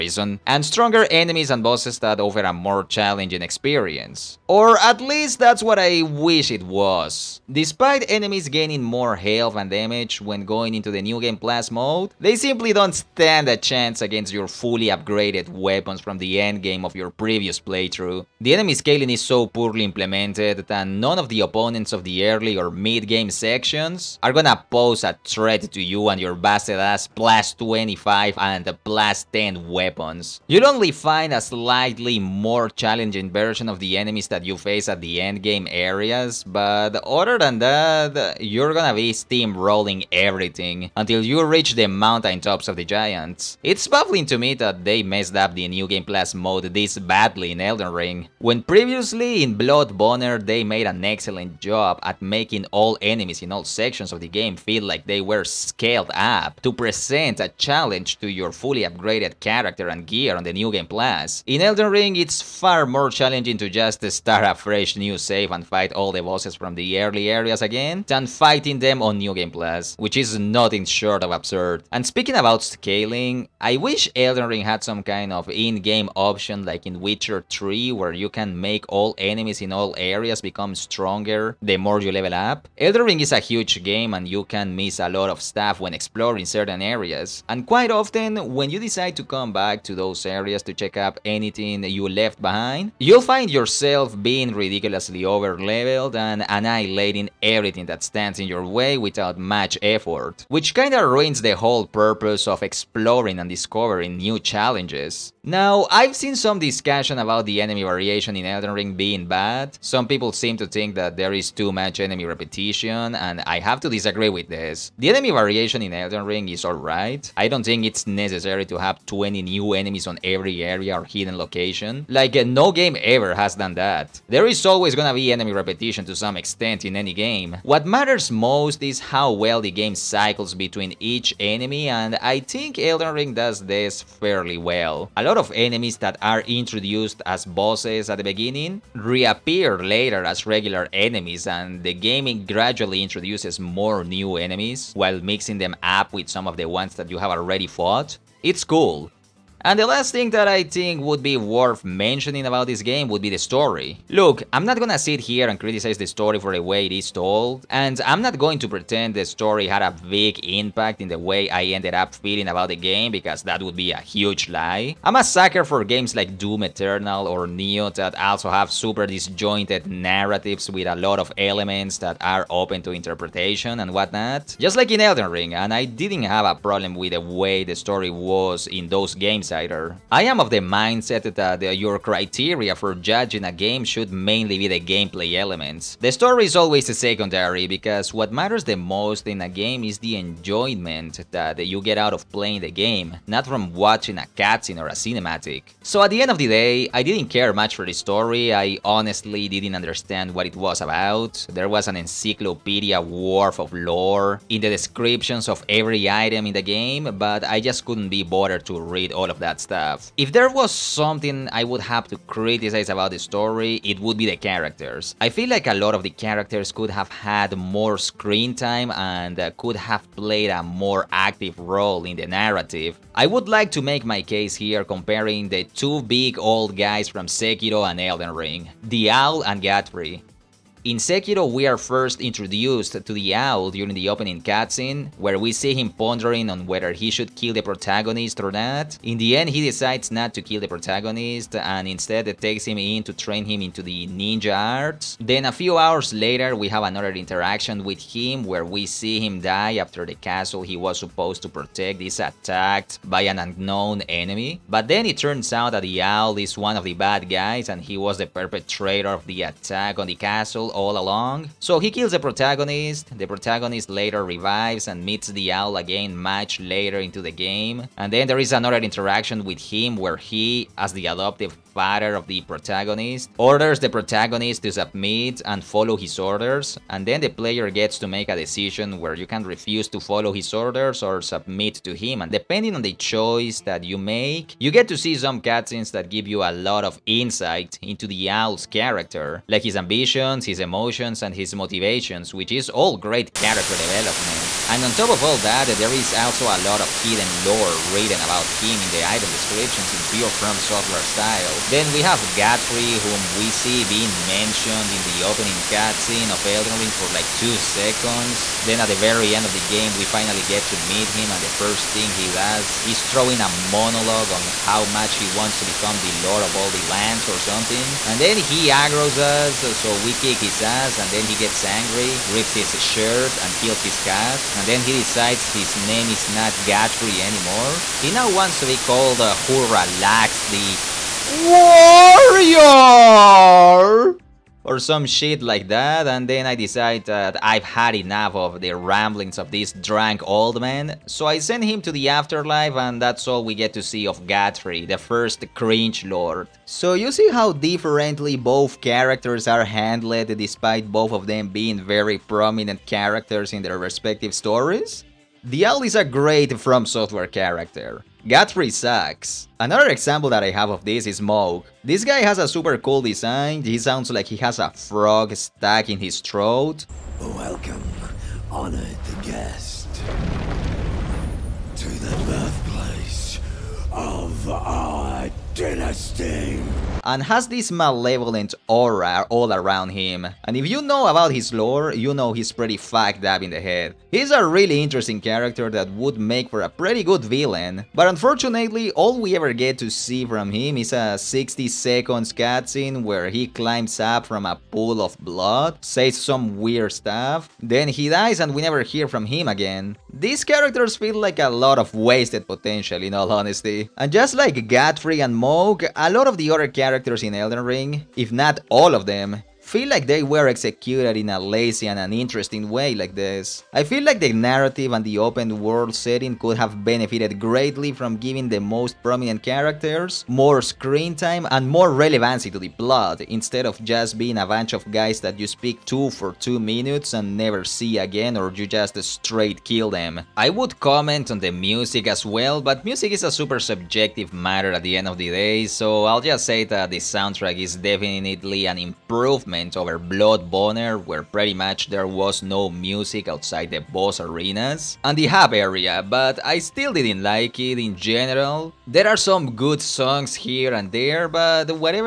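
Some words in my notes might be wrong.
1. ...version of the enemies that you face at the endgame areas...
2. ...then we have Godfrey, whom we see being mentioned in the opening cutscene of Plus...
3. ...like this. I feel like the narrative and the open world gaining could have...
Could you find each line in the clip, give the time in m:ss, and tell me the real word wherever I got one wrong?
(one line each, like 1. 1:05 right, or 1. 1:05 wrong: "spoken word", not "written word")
1. 0:33 right
2. 5:01 wrong: "Elden", not "Plus"
3. 6:52 wrong: "setting", not "gaining".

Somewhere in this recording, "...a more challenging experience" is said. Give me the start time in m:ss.
0:02.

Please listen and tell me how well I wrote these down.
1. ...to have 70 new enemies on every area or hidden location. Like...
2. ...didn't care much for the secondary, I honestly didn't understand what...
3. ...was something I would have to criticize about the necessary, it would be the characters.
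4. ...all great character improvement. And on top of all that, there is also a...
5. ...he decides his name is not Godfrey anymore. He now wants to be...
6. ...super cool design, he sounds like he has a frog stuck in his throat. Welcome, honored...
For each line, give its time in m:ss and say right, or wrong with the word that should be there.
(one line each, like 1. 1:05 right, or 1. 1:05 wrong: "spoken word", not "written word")
1. 1:58 wrong: "20", not "70"
2. 3:17 wrong: "story", not "secondary"
3. 3:30 wrong: "story", not "necessary"
4. 4:52 wrong: "development", not "improvement"
5. 5:24 right
6. 6:02 right.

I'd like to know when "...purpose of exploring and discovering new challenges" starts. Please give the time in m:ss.
1:41.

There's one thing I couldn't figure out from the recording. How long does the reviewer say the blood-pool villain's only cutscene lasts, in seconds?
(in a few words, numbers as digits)
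60.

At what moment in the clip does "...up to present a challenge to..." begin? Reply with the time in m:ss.
0:56.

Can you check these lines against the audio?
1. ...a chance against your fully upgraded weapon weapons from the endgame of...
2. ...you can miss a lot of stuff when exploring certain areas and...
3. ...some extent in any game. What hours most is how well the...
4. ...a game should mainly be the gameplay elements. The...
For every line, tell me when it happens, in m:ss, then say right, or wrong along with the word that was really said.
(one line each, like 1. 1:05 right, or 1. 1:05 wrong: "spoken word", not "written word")
1. 0:13 right
2. 1:24 right
3. 2:06 wrong: "matters", not "hours"
4. 3:03 right.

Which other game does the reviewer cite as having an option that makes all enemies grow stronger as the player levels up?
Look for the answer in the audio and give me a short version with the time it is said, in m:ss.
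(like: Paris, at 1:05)
Witcher 3, at 1:16.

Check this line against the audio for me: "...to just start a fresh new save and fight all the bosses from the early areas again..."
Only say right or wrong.
right.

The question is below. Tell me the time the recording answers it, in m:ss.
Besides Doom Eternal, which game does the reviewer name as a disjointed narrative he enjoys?
2:47.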